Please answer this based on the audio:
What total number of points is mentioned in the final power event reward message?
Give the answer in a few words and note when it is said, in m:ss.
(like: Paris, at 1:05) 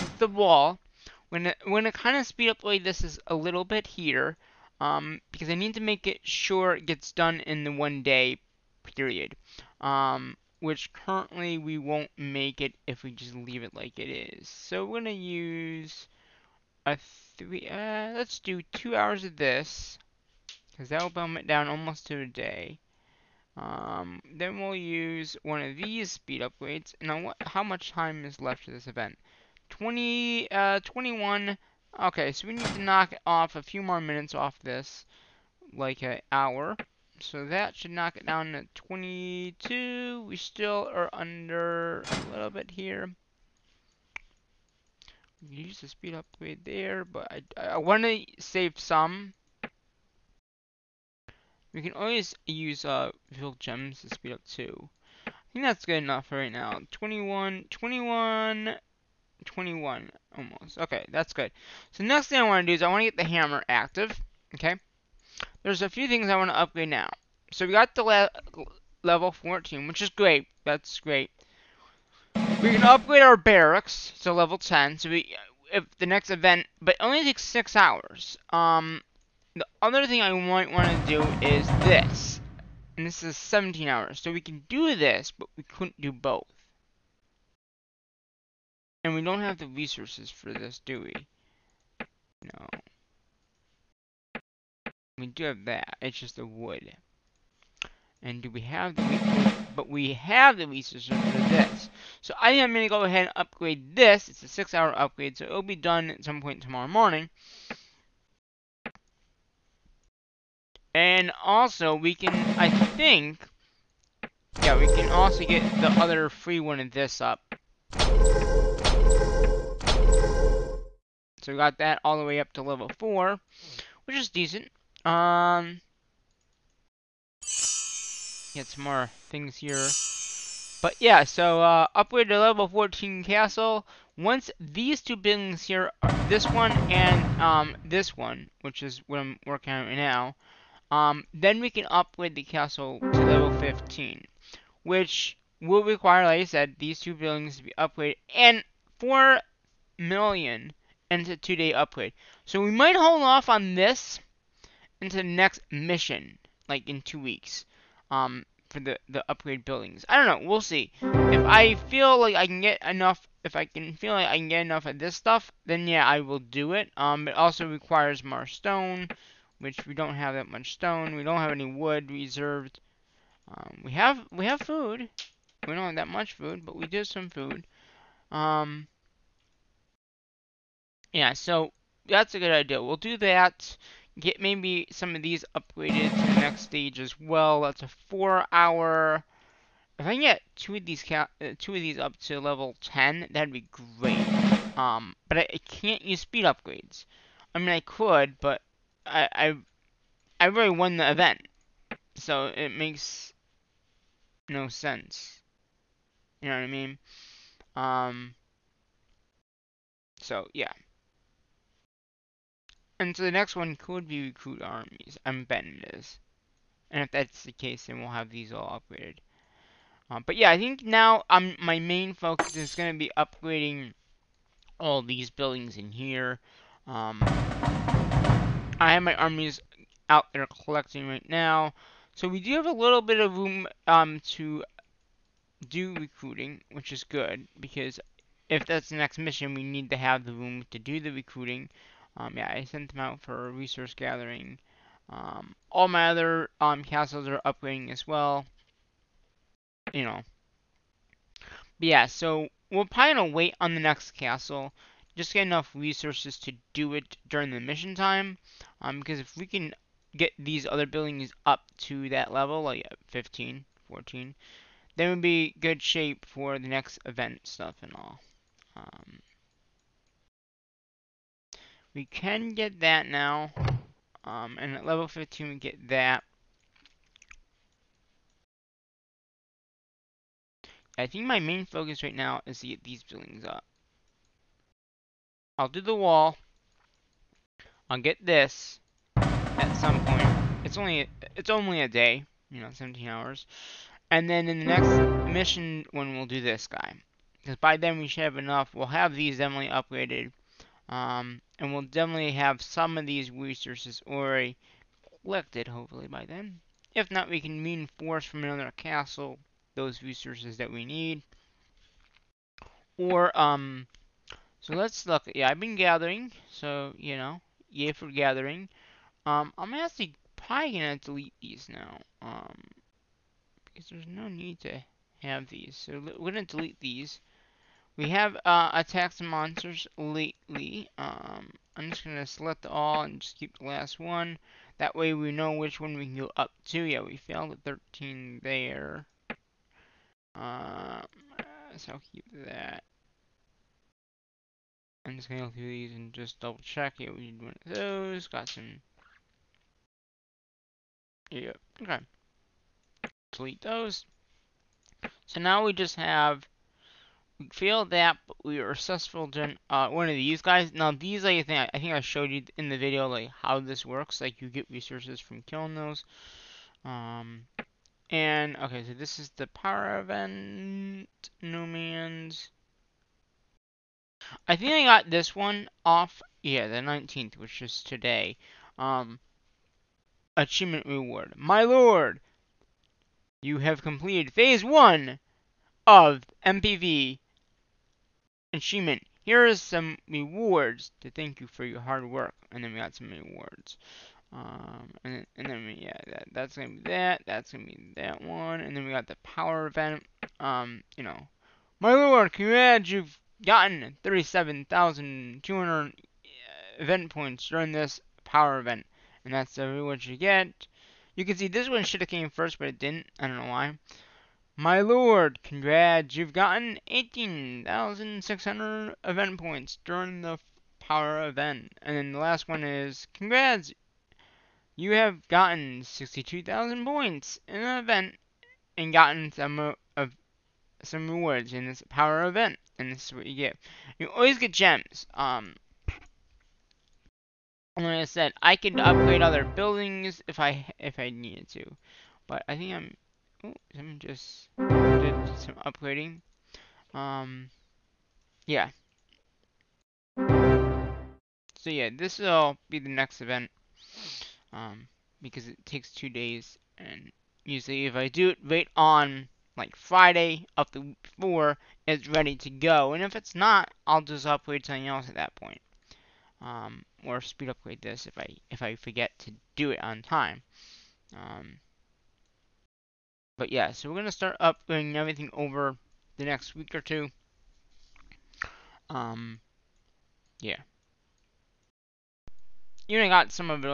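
62,000, at 7:05.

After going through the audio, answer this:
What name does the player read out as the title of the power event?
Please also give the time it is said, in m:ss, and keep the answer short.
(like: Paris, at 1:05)
Numians, at 6:11.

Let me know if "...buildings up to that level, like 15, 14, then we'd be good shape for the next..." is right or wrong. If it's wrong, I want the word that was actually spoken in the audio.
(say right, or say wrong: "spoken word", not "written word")
right.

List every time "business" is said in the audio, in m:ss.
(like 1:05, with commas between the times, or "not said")
not said.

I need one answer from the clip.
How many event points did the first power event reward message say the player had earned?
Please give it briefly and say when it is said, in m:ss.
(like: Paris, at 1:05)
37,200, at 6:44.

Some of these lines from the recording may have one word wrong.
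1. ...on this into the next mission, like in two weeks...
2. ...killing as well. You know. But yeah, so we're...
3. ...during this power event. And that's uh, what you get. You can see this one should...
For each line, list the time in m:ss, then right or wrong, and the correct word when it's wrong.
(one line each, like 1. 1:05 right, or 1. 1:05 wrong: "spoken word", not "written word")
1. 2:33 right
2. 4:07 wrong: "upgrading", not "killing"
3. 6:47 right.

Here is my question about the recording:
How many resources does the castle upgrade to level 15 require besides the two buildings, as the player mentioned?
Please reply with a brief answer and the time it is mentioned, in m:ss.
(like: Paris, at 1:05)
4 million, at 2:28.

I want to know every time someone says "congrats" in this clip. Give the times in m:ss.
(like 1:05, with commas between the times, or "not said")
6:42, 6:55, 7:03.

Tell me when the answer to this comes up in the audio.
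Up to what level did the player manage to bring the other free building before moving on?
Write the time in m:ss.
2:02.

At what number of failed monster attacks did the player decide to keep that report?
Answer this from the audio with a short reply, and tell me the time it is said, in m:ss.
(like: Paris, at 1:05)
13, at 5:37.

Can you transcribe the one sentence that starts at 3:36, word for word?
And if that's the case, then we'll have these all upgraded.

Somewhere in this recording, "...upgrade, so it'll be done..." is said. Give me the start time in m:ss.
1:44.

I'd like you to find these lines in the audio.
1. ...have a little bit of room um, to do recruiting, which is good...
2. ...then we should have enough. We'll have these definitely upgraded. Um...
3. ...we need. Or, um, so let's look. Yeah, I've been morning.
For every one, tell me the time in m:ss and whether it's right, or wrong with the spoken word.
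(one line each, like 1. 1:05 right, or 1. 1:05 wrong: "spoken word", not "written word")
1. 3:52 right
2. 4:57 right
3. 5:10 wrong: "gathering", not "morning".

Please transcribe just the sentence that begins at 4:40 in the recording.
I think my main focus right now is to get these buildings up.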